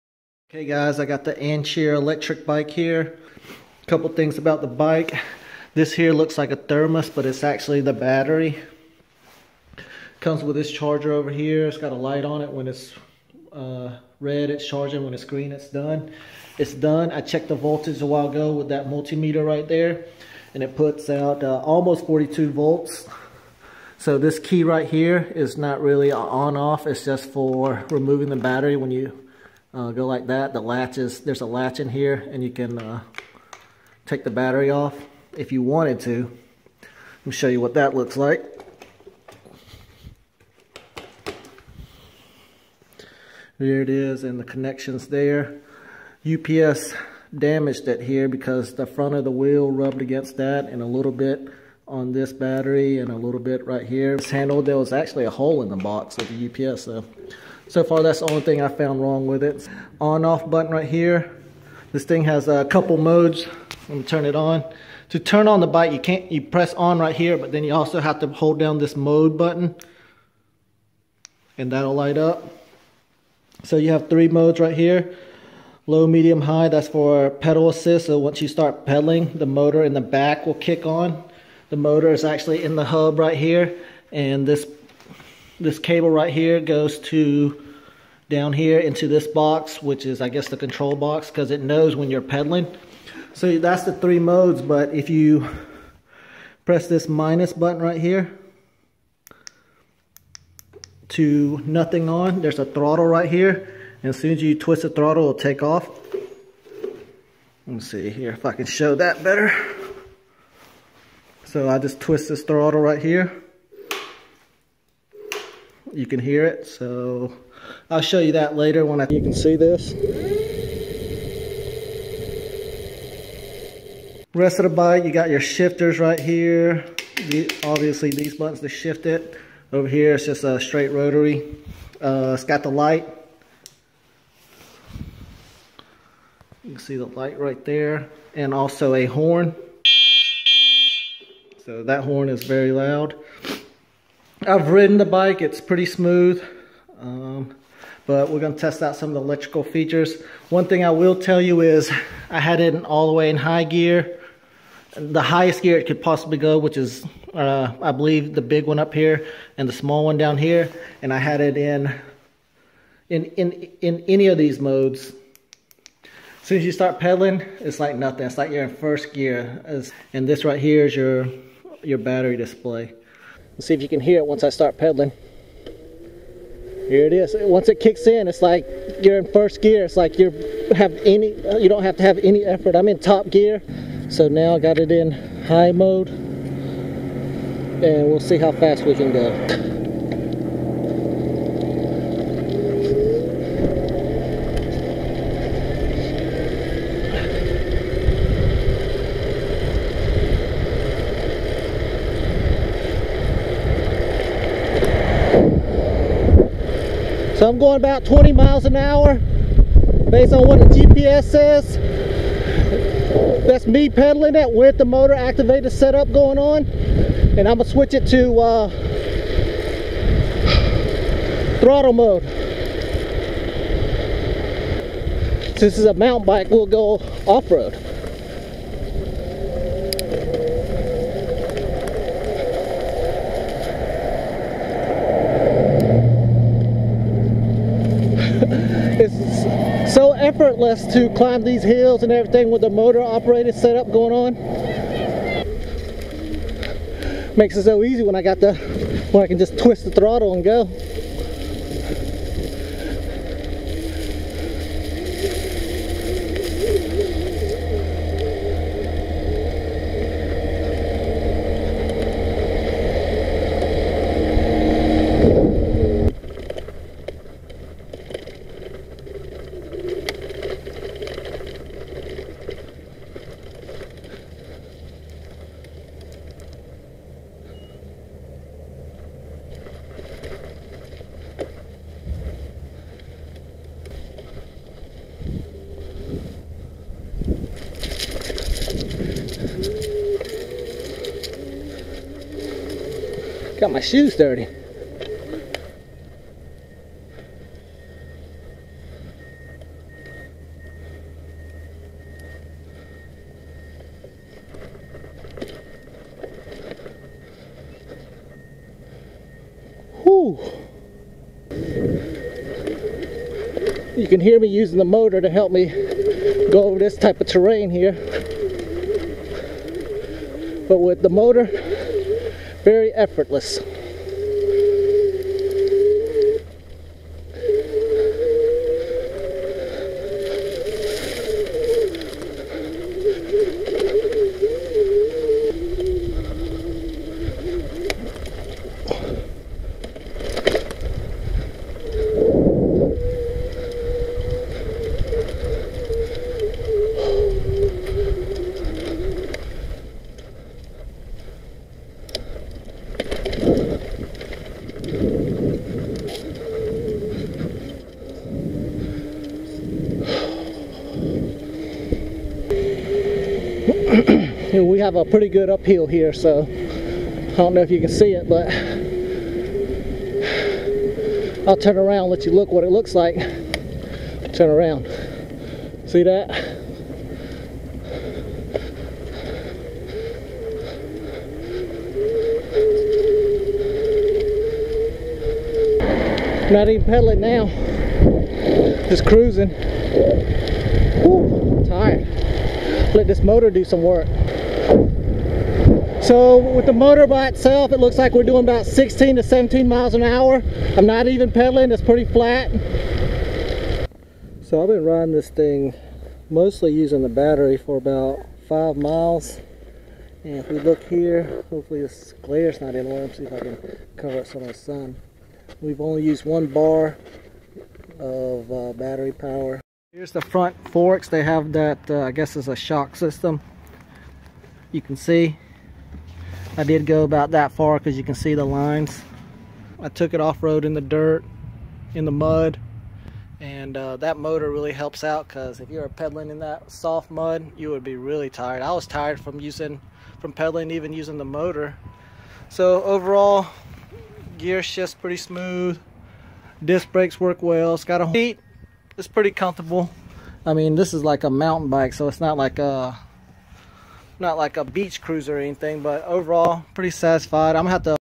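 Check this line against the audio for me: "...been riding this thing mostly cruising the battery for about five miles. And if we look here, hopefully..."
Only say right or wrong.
wrong.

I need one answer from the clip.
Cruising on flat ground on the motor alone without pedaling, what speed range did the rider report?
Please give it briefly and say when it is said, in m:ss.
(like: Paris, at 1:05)
16 to 17 mph, at 6:38.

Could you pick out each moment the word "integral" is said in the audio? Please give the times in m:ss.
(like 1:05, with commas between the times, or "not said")
not said.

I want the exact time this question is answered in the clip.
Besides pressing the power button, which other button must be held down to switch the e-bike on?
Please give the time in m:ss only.
1:08.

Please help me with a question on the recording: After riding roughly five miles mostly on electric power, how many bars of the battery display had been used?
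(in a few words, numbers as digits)
1.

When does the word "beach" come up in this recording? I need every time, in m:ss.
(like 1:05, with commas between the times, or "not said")
7:34.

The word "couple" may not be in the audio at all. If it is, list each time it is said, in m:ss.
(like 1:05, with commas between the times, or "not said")
0:03, 1:02.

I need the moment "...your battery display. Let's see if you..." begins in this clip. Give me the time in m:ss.
2:51.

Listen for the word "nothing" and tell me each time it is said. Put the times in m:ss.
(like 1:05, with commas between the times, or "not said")
1:41, 2:47.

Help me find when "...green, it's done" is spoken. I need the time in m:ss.
0:15.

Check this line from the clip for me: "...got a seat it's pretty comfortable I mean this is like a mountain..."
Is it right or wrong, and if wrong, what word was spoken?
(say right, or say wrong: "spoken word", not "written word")
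right.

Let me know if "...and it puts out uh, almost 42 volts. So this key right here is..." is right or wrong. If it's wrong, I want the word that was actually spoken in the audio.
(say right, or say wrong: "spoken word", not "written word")
right.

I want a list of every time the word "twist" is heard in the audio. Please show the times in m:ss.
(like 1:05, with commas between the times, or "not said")
1:44, 1:51, 4:09.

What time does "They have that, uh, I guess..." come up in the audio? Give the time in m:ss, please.
7:01.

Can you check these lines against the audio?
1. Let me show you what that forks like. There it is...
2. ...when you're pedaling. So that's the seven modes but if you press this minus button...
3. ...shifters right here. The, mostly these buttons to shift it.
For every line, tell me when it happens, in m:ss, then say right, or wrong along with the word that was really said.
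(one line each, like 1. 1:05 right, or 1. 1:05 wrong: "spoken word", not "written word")
1. 0:36 wrong: "looks", not "forks"
2. 1:31 wrong: "three", not "seven"
3. 2:05 wrong: "obviously", not "mostly".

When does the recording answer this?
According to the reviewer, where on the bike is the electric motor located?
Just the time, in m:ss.
1:22.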